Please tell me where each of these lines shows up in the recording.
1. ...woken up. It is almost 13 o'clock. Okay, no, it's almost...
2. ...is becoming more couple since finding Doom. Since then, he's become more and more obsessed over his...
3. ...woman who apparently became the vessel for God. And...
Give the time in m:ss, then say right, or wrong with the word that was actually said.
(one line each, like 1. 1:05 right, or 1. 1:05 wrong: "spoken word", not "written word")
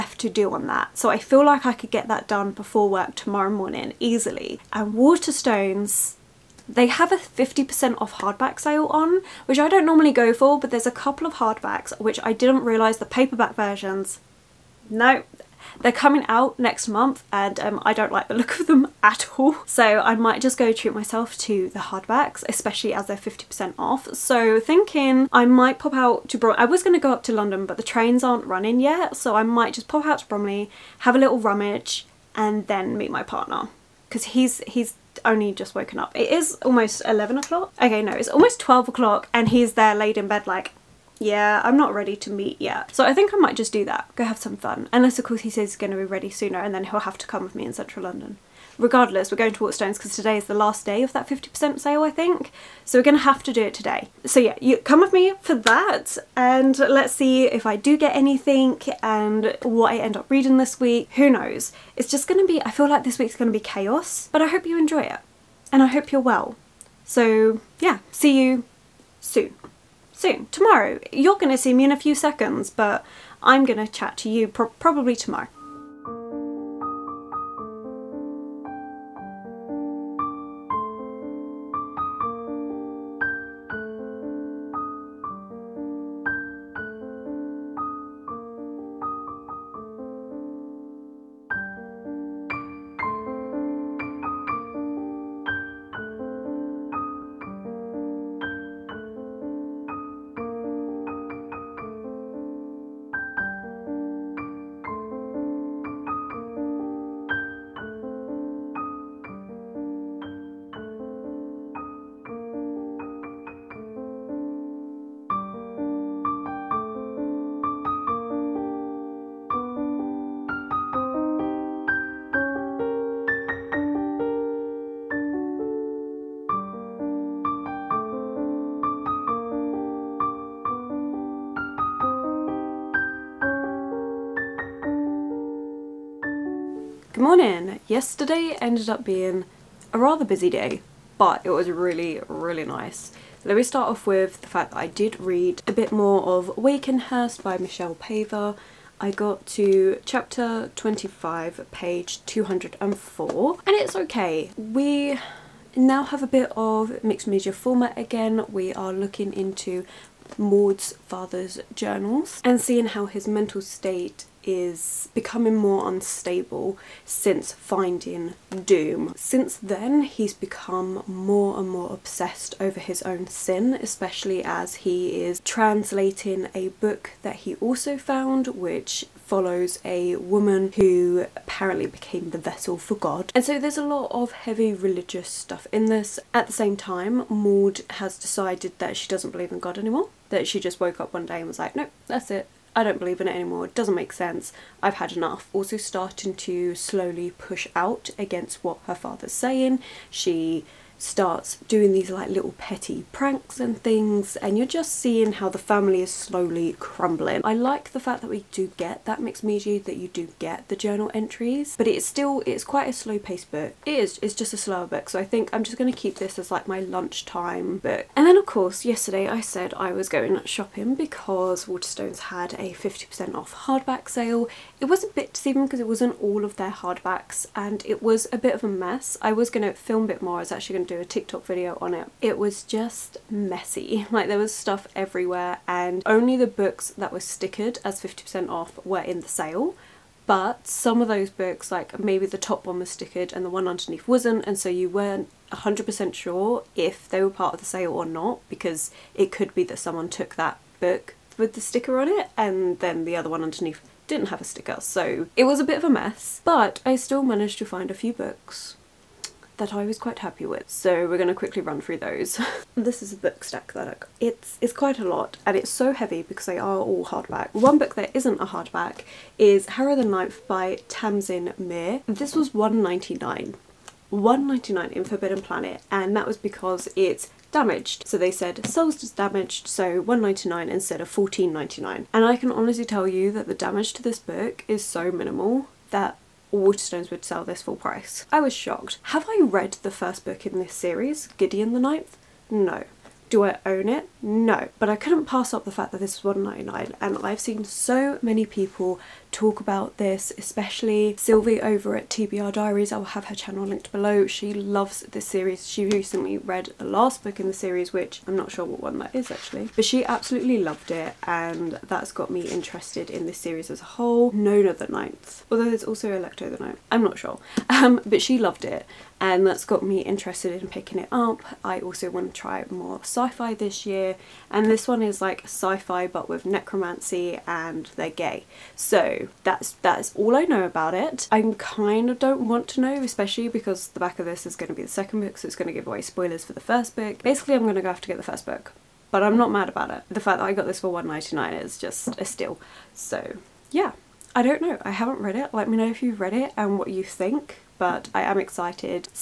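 1. 0:35 wrong: "11", not "13"
2. 2:44 wrong: "unstable", not "couple"
3. 3:00 right.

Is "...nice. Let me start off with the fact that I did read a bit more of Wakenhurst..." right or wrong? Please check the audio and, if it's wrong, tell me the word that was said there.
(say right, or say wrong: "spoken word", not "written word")
right.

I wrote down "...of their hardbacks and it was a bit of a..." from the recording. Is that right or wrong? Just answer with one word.
right.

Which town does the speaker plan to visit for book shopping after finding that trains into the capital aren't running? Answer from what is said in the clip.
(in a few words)
Bromley.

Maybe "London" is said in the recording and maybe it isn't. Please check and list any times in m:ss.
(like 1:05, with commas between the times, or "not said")
0:27, 0:48.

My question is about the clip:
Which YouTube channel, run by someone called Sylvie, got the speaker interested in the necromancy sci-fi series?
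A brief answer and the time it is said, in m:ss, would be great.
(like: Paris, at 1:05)
TBR Diaries, at 5:02.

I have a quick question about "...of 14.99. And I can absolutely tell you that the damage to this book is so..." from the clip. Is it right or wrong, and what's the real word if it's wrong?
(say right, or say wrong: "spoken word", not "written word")
wrong: "honestly", not "absolutely".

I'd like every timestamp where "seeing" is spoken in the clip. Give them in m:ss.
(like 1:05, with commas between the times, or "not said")
2:42, 3:24.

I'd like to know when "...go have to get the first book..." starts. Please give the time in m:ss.
5:37.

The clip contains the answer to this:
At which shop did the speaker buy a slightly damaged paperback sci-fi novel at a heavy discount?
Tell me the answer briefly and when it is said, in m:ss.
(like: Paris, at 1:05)
Forbidden Planet, at 4:35.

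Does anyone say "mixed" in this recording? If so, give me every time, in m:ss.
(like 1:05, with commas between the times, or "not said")
2:37, 3:29.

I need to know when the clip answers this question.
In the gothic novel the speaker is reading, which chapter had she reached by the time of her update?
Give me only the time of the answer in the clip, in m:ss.
2:30.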